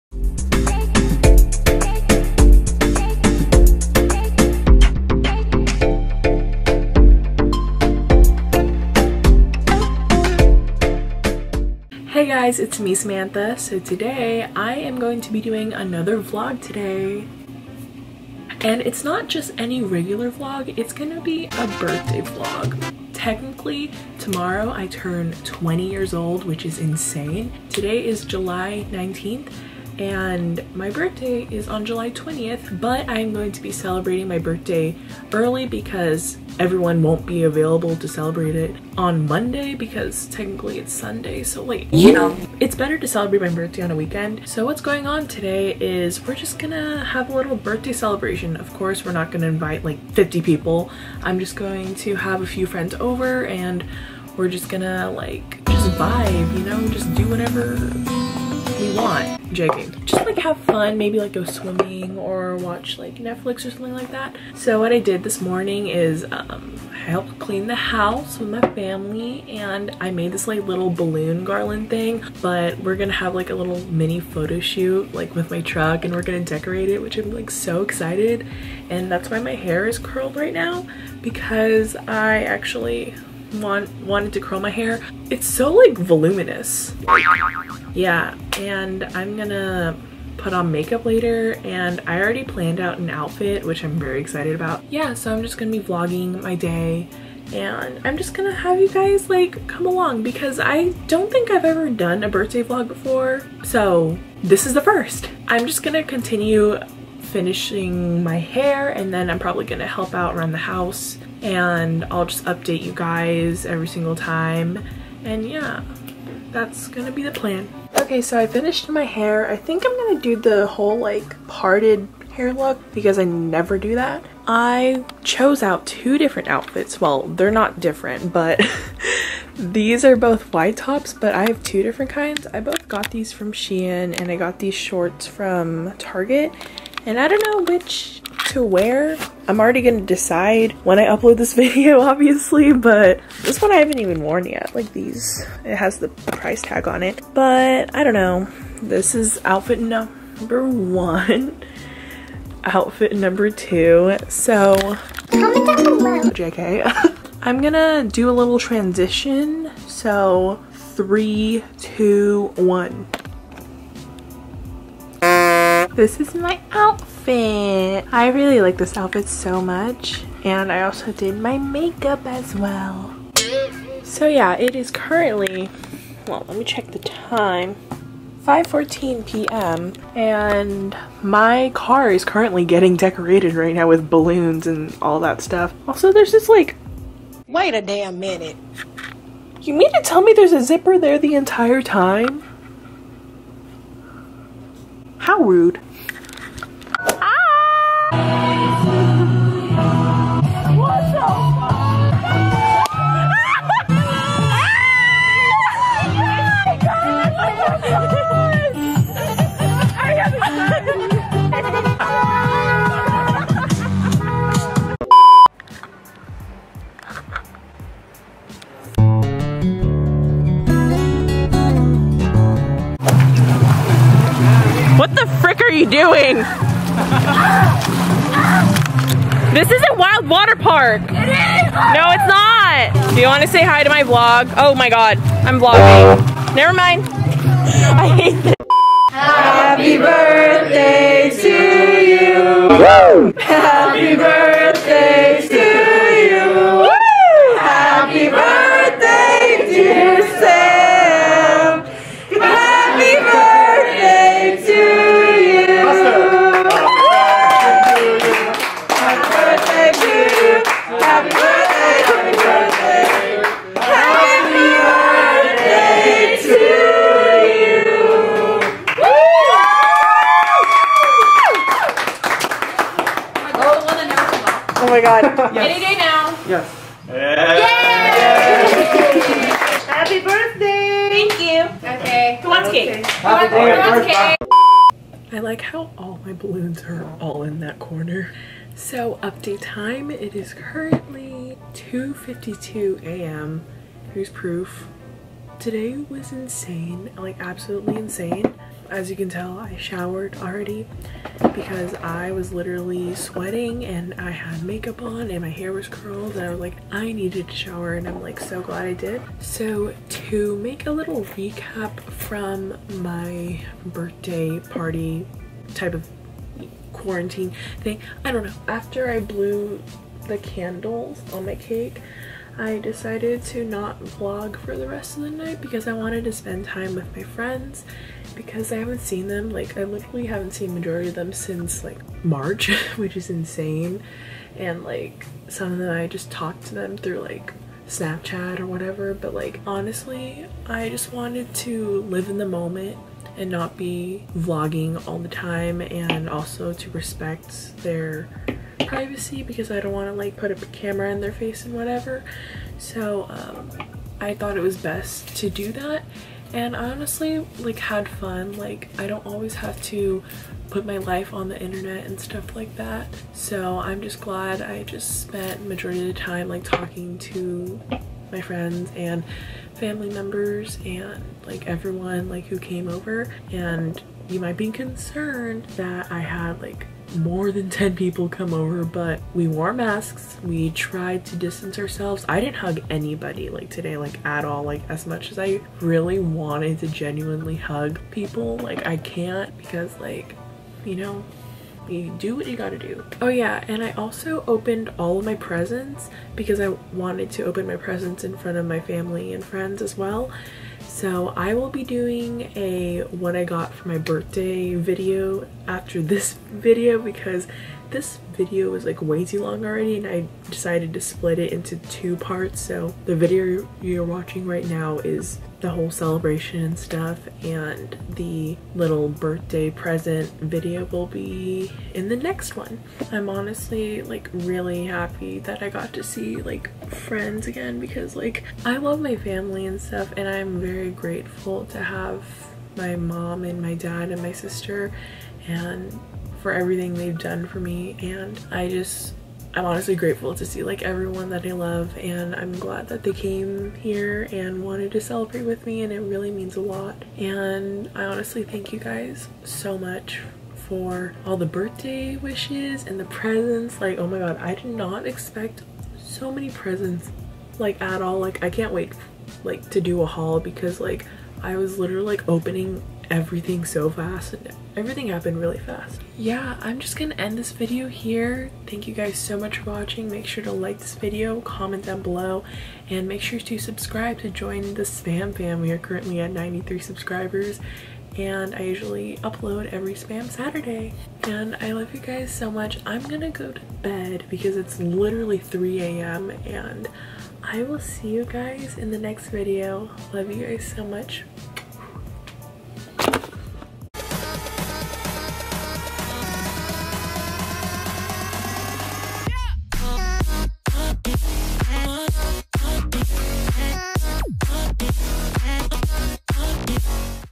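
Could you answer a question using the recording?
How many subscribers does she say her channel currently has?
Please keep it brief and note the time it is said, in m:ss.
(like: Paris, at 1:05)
93, at 7:56.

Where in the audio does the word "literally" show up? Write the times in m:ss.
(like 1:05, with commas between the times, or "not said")
5:02, 5:29, 7:41, 8:04.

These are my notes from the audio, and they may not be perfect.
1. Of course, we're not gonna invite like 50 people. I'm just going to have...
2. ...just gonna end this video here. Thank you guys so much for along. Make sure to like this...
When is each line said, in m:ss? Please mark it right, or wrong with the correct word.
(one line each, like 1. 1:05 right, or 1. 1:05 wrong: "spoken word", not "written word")
1. 0:48 right
2. 7:46 wrong: "watching", not "along".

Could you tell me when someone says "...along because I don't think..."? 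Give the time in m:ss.
1:39.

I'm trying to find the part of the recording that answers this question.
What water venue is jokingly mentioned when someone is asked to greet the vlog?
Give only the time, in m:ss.
3:49.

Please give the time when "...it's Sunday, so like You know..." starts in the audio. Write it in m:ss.
0:40.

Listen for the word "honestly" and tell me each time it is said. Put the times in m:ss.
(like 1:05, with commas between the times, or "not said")
5:39, 5:56, 7:03, 7:19, 7:28.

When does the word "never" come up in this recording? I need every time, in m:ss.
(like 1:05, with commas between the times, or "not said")
2:03, 3:56.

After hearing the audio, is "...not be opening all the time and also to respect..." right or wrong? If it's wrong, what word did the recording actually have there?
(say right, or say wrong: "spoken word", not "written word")
wrong: "vlogging", not "opening".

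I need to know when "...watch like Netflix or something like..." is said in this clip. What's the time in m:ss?
1:02.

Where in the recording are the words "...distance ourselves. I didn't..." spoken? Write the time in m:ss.
6:21.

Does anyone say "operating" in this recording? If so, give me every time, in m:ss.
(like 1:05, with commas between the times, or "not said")
not said.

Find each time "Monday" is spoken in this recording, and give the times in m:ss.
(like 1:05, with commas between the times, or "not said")
0:39.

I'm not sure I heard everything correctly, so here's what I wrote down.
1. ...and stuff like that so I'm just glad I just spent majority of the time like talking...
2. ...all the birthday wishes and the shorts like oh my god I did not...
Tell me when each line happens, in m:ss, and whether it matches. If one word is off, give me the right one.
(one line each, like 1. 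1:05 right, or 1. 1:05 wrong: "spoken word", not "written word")
1. 6:02 right
2. 7:31 wrong: "presents", not "shorts".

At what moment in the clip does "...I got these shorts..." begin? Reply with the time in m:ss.
2:14.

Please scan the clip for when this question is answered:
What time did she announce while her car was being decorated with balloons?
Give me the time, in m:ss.
2:58.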